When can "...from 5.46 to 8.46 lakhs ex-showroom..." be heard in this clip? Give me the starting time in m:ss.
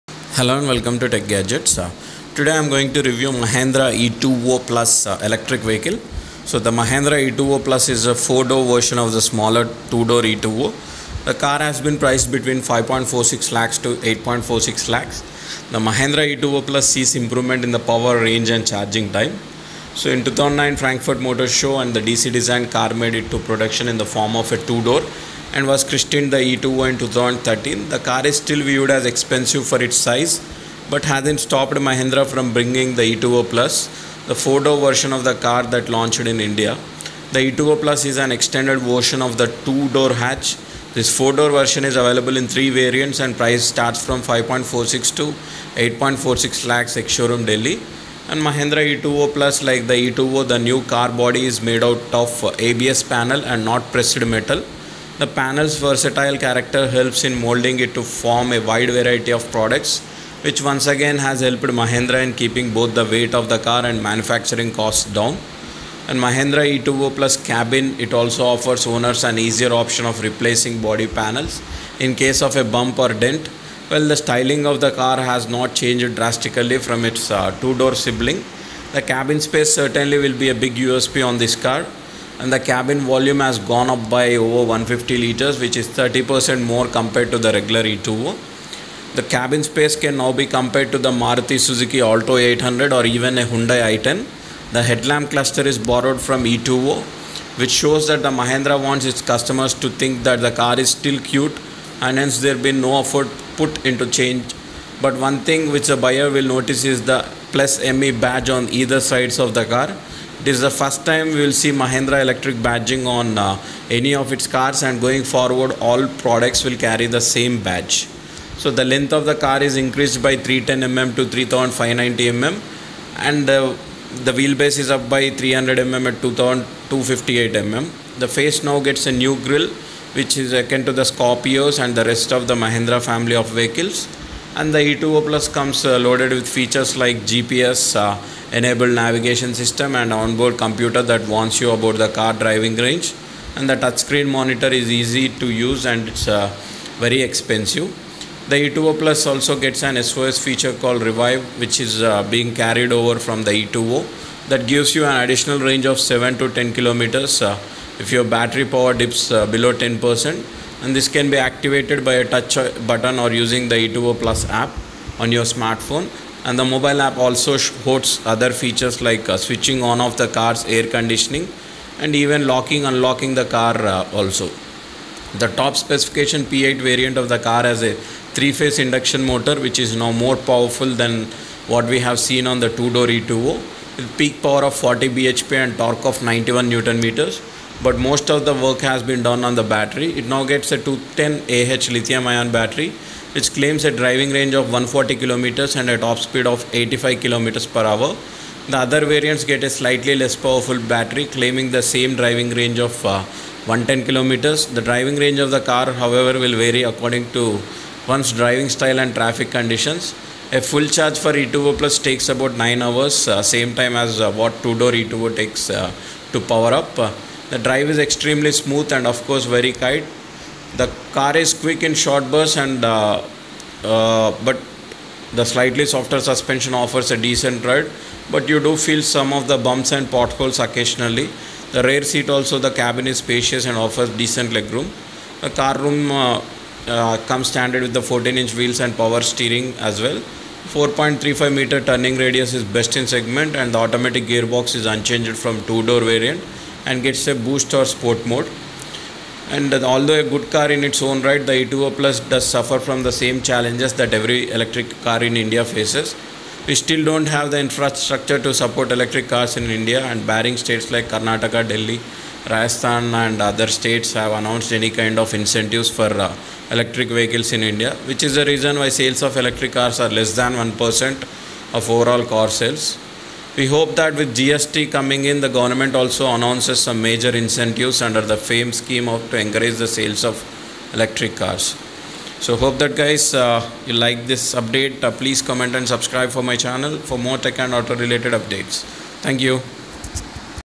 0:44.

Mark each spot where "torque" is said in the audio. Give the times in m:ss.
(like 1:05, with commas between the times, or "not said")
3:05.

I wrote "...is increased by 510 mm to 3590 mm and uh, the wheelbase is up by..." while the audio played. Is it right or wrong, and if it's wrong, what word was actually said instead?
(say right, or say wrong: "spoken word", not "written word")
wrong: "310", not "510".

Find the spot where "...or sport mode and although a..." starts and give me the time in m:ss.
4:07.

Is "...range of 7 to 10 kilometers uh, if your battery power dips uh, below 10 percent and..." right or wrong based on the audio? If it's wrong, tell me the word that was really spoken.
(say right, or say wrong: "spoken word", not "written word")
right.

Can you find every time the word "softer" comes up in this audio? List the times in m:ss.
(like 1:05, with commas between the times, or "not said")
3:45.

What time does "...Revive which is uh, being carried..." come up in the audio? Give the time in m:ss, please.
2:31.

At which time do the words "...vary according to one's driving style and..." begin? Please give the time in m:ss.
3:26.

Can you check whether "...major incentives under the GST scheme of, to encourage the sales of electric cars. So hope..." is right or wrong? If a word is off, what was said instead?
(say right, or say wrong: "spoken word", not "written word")
wrong: "FAME", not "GST".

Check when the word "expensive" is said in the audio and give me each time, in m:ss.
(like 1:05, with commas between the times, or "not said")
0:29, 2:27.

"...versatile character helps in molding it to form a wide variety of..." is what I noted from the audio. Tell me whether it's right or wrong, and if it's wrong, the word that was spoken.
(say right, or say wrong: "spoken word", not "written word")
right.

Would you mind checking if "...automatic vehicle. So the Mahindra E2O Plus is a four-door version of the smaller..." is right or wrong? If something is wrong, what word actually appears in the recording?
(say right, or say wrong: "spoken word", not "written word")
wrong: "electric", not "automatic".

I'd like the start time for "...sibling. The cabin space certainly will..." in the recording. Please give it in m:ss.
1:17.